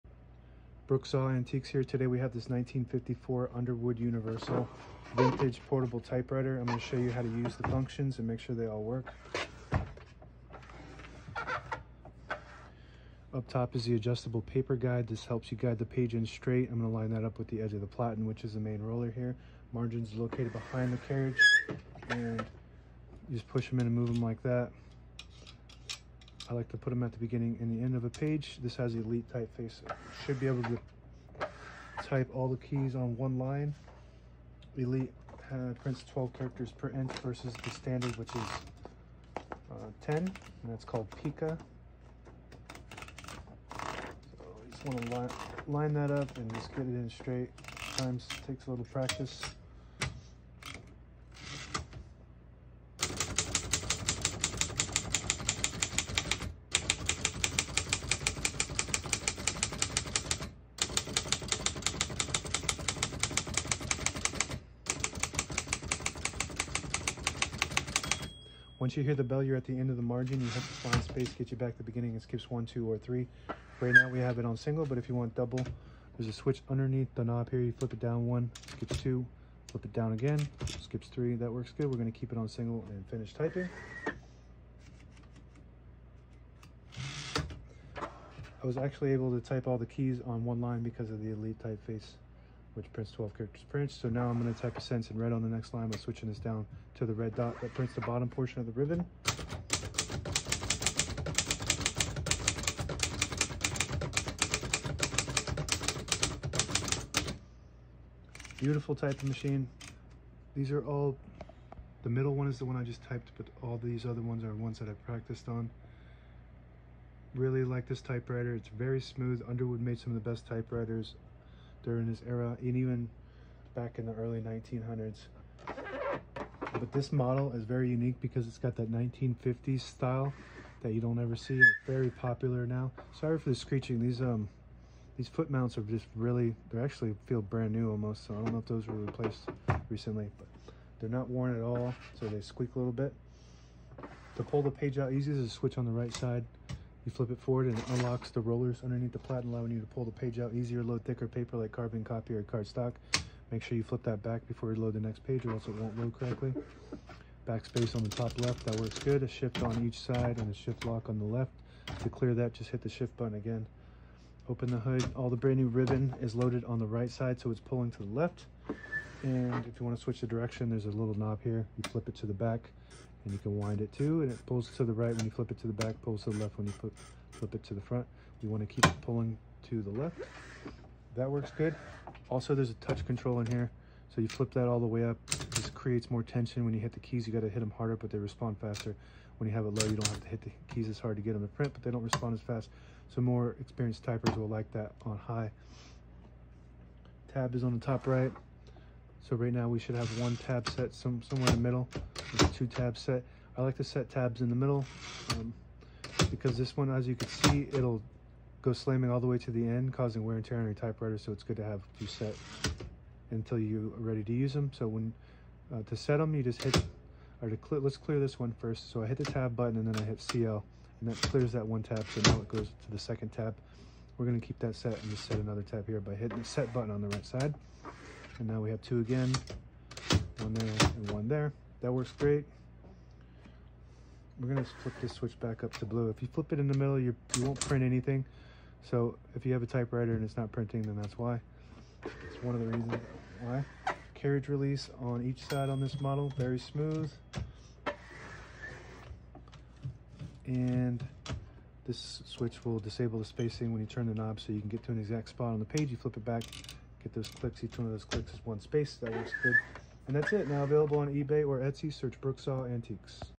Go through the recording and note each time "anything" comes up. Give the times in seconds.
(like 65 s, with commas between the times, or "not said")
237 s.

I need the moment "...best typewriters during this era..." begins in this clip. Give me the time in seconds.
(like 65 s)
120 s.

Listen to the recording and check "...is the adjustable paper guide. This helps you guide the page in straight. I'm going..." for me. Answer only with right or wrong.
right.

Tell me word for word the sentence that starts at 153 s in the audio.
Make sure you flip that back before you load the next page or else it won't load correctly.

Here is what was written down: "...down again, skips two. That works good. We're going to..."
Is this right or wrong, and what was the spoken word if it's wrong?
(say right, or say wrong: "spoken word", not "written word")
wrong: "three", not "two".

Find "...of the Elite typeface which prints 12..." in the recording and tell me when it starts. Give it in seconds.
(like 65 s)
91 s.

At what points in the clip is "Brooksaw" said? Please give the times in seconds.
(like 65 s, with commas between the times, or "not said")
0 s, 262 s.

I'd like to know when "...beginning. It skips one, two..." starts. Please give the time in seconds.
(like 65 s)
71 s.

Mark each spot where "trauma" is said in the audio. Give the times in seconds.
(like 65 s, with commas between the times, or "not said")
not said.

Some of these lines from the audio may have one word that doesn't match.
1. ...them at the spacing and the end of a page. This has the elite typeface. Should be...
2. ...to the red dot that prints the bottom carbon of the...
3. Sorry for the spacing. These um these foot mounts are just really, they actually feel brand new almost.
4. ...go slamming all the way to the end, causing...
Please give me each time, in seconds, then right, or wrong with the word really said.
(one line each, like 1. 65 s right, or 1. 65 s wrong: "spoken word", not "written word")
1. 26 s wrong: "beginning", not "spacing"
2. 96 s wrong: "portion", not "carbon"
3. 133 s wrong: "screeching", not "spacing"
4. 208 s right.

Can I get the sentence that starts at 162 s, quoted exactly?
To clear that, just hit the shift button again.